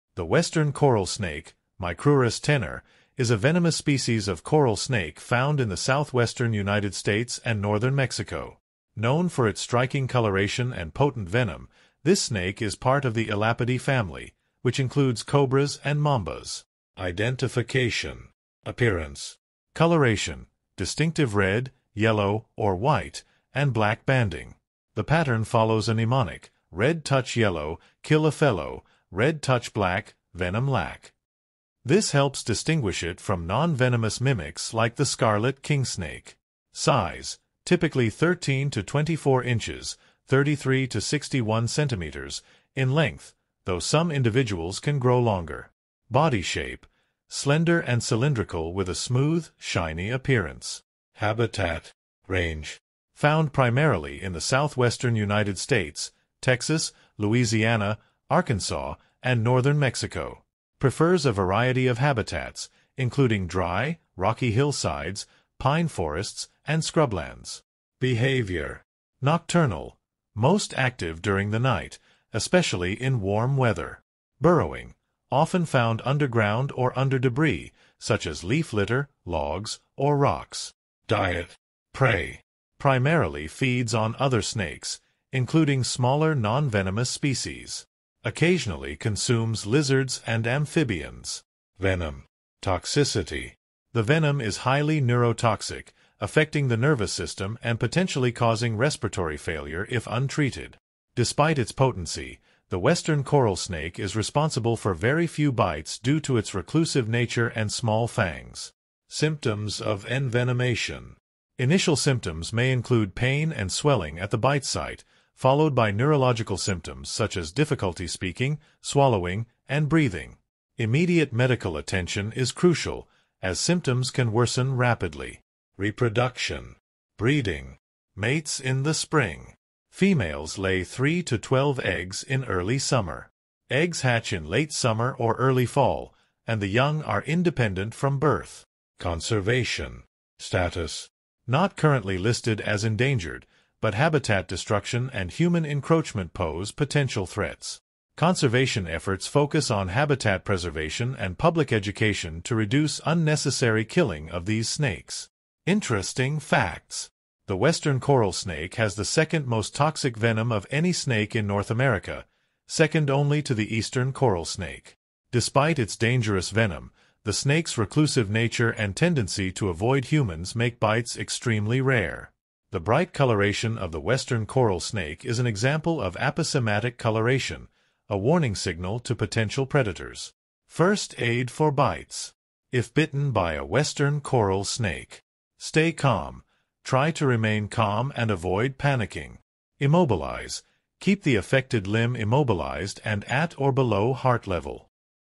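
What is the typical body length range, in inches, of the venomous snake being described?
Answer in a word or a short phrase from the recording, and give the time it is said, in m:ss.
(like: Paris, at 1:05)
13 to 24 inches, at 0:38.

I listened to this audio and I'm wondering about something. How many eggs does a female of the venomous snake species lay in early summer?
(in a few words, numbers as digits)
3 to 12.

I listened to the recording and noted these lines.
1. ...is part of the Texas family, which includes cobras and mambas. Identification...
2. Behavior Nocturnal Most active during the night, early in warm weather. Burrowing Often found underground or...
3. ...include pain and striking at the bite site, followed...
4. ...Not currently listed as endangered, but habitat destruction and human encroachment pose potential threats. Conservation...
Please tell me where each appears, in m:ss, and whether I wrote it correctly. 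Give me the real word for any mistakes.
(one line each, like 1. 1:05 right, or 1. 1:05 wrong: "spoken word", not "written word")
1. 0:12 wrong: "Elapidae", not "Texas"
2. 1:07 wrong: "especially", not "early"
3. 1:52 wrong: "swelling", not "striking"
4. 2:21 right.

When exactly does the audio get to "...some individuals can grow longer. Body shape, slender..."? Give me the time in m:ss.
0:43.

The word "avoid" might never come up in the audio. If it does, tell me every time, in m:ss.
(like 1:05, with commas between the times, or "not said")
2:49, 3:08.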